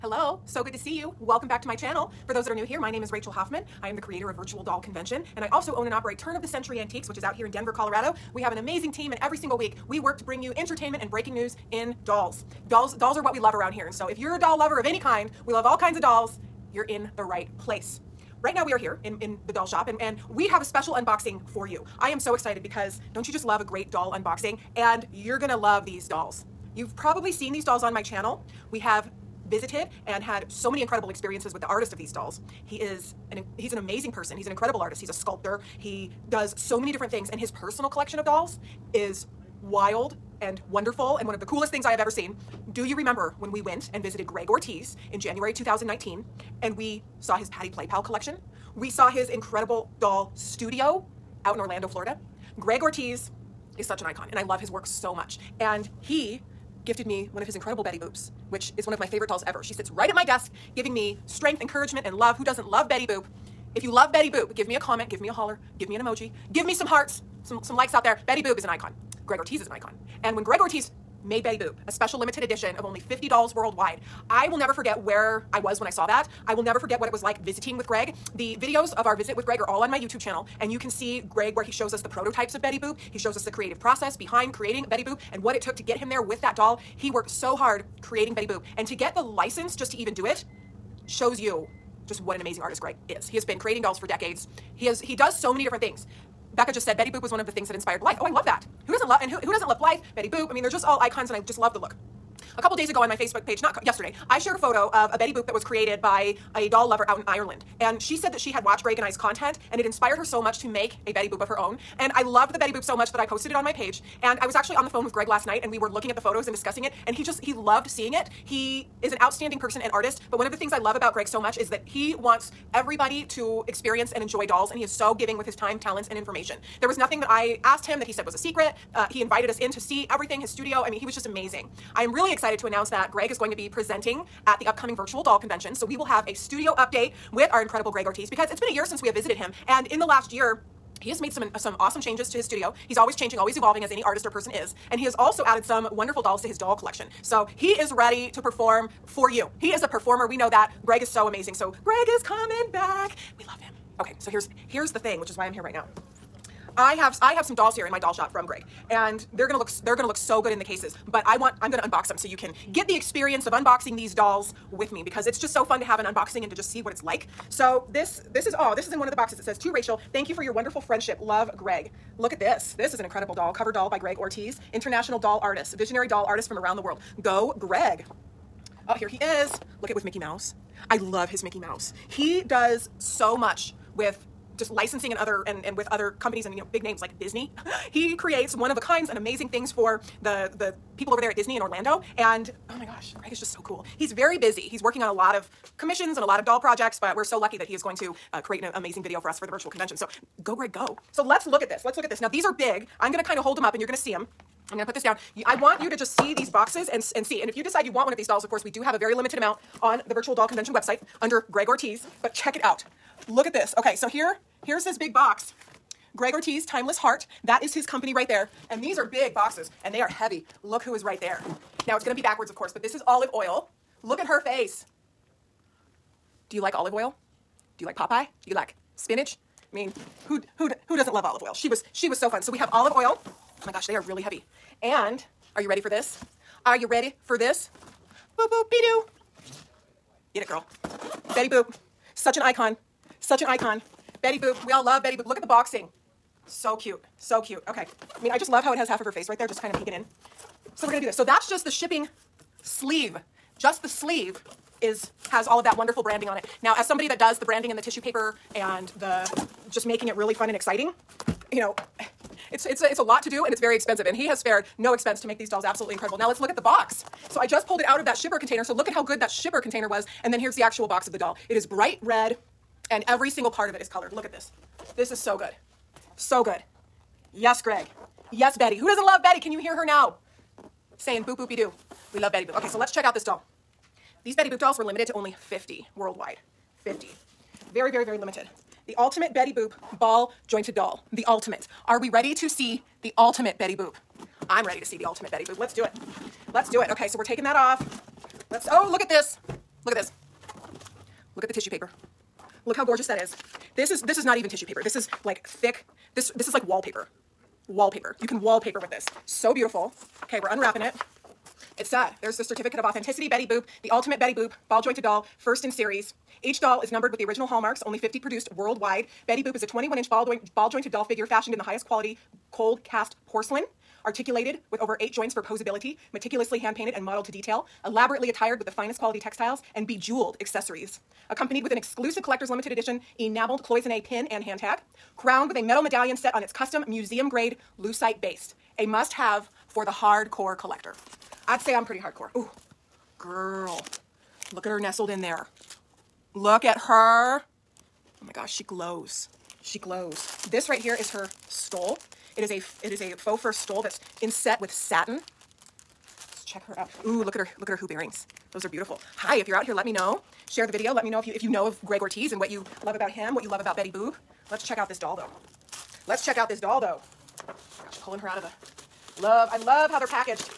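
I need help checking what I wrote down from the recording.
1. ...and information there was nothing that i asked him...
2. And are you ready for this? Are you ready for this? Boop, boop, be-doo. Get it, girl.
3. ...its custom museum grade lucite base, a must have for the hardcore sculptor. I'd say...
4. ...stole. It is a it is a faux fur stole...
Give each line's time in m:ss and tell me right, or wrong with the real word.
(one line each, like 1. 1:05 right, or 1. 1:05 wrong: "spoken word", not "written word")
1. 2:06 right
2. 3:54 right
3. 5:36 wrong: "collector", not "sculptor"
4. 5:51 right.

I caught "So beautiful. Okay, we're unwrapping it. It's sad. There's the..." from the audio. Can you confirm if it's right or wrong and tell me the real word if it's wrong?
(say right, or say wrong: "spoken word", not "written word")
right.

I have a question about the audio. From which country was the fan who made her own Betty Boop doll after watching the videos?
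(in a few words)
Ireland.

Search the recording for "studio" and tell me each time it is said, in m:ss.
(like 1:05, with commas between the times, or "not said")
0:50, 2:10, 2:16, 2:22.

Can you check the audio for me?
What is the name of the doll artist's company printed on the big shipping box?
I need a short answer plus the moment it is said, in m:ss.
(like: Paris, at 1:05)
Timeless Heart, at 3:36.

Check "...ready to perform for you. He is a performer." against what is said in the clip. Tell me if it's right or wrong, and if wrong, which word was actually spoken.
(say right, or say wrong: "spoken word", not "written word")
right.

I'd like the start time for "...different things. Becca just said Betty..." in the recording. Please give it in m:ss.
1:35.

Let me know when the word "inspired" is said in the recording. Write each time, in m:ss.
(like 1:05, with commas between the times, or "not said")
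1:37, 1:49.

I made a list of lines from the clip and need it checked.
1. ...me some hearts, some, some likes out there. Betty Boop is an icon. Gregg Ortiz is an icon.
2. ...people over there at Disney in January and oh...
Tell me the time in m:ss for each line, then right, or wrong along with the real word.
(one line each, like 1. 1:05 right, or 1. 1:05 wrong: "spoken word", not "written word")
1. 1:06 right
2. 3:10 wrong: "Orlando", not "January".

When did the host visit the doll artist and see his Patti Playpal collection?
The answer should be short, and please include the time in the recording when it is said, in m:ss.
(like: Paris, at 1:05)
January 2019, at 0:45.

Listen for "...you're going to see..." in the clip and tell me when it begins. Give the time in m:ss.
3:23.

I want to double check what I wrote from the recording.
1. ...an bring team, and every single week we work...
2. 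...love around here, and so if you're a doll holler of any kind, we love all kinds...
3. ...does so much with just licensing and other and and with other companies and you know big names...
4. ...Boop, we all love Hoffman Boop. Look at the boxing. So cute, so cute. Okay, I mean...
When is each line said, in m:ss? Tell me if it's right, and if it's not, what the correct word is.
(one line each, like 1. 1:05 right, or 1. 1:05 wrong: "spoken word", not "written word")
1. 0:08 wrong: "amazing", not "bring"
2. 0:13 wrong: "lover", not "holler"
3. 3:02 right
4. 4:04 wrong: "Betty", not "Hoffman".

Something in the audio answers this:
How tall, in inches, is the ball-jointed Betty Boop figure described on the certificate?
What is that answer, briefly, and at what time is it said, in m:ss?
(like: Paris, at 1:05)
21 inches, at 5:19.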